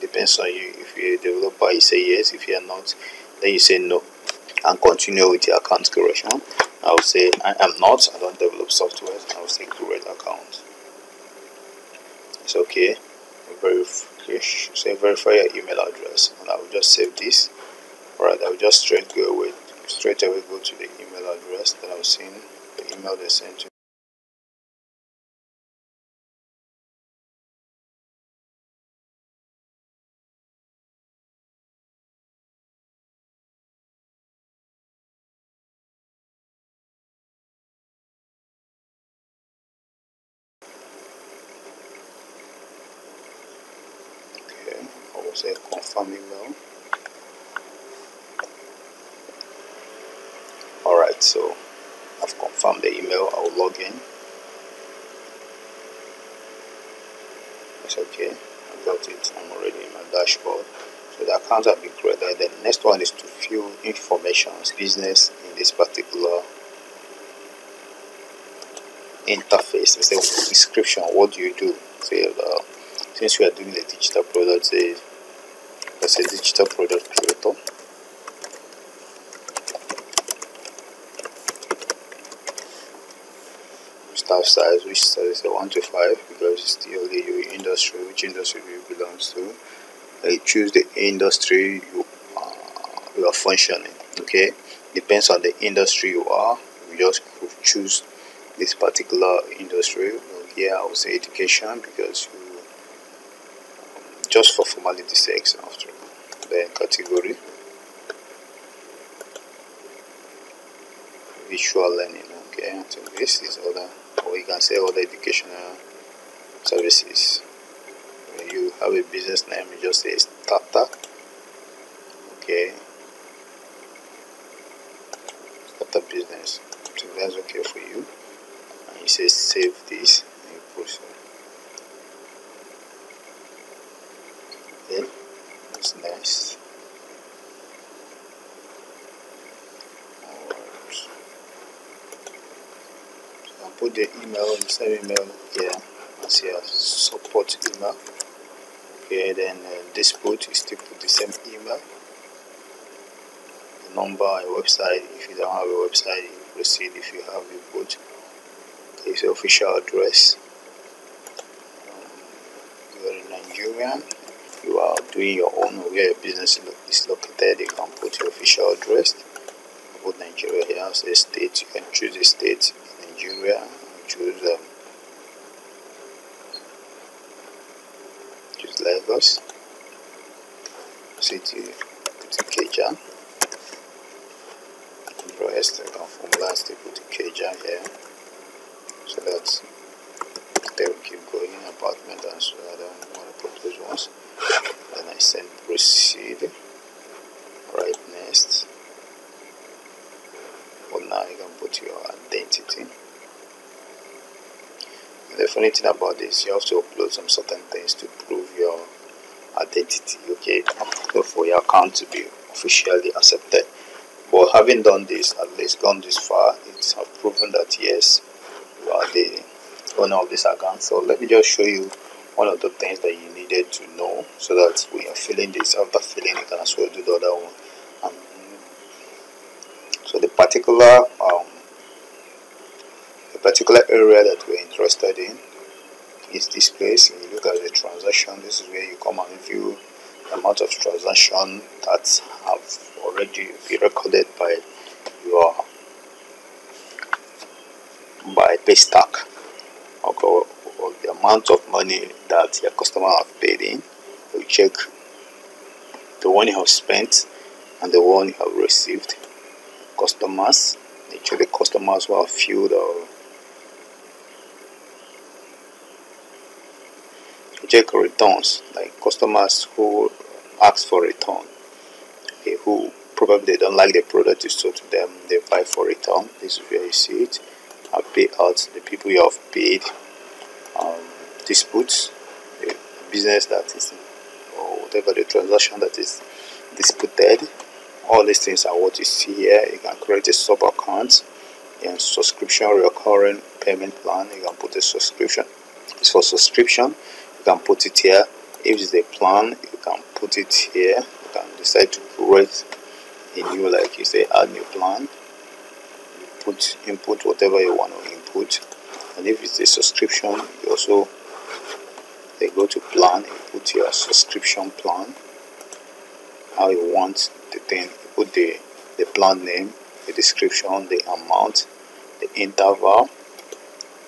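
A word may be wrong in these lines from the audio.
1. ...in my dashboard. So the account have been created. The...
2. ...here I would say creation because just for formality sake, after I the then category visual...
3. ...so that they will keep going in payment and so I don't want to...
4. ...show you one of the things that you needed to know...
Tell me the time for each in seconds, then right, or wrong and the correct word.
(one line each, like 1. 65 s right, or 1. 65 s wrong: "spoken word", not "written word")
1. 59 s right
2. 100 s wrong: "education", not "creation"
3. 189 s wrong: "apartment", not "payment"
4. 221 s right.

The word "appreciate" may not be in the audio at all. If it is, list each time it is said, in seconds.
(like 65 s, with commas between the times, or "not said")
not said.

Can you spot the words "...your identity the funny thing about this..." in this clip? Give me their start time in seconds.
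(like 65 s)
201 s.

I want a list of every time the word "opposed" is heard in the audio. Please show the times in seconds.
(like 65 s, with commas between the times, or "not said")
not said.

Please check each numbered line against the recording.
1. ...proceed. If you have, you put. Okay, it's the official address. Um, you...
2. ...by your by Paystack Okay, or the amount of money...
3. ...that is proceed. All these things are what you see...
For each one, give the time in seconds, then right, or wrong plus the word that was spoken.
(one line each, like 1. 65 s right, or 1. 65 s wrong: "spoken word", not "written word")
1. 156 s right
2. 244 s right
3. 285 s wrong: "disputed", not "proceed".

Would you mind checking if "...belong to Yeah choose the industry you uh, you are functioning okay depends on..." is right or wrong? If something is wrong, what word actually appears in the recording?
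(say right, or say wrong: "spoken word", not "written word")
wrong: "You", not "Yeah".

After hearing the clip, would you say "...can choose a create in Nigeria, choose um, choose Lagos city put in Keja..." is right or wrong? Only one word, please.
wrong.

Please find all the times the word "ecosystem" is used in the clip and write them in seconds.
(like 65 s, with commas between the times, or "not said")
not said.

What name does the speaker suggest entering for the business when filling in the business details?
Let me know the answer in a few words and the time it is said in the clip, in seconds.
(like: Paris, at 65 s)
Starter business, at 125 s.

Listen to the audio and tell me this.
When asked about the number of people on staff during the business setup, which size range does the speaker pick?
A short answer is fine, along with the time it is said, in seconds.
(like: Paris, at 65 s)
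1 to 5, at 85 s.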